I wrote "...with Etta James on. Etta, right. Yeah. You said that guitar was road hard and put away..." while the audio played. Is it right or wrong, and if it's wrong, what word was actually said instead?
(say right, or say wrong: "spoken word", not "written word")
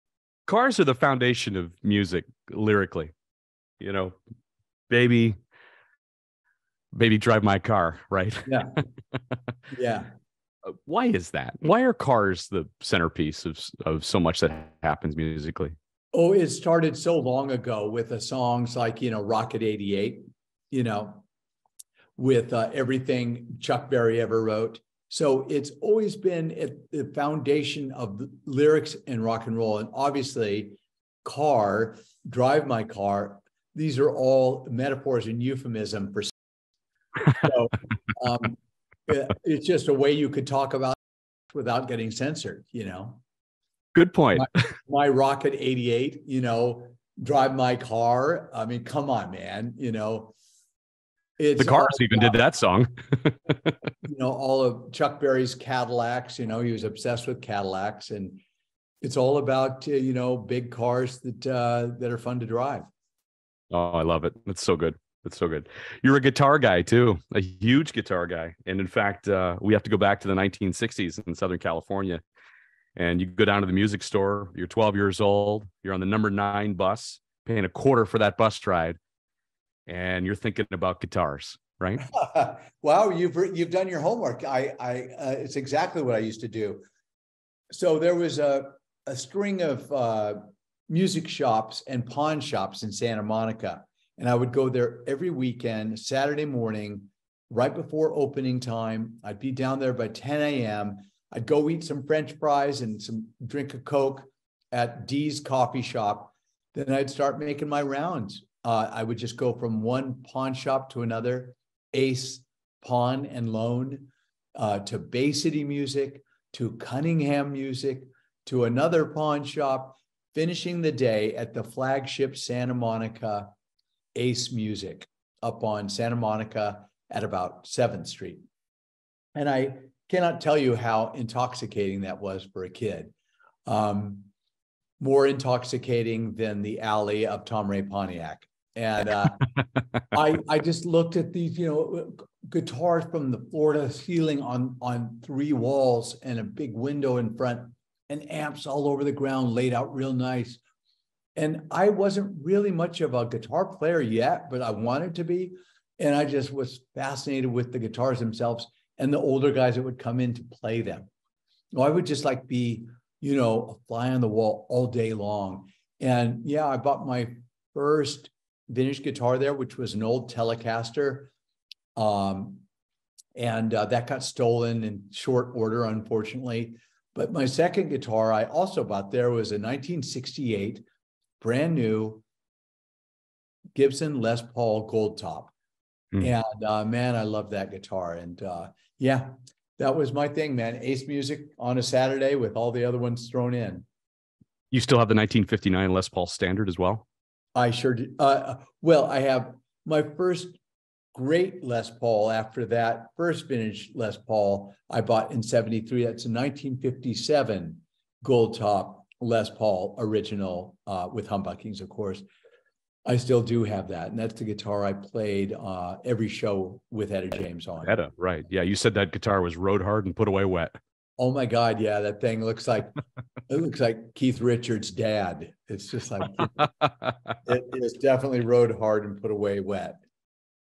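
right.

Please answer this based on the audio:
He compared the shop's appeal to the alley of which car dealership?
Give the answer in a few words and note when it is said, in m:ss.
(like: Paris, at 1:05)
Tom Ray Pontiac, at 2:17.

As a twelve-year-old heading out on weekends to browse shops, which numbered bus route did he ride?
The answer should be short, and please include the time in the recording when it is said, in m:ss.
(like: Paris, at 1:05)
9, at 1:16.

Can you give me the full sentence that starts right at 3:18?
Uh, uh, well, I have my first great Les Paul after that first vintage Les Paul I bought in 73.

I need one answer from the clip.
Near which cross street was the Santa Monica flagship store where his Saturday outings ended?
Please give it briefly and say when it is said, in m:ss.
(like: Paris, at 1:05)
7th Street, at 2:07.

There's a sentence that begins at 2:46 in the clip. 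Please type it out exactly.
And yeah, I bought my first vintage guitar there, which was an old Telecaster.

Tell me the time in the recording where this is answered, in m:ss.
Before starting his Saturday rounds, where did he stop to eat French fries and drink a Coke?
1:45.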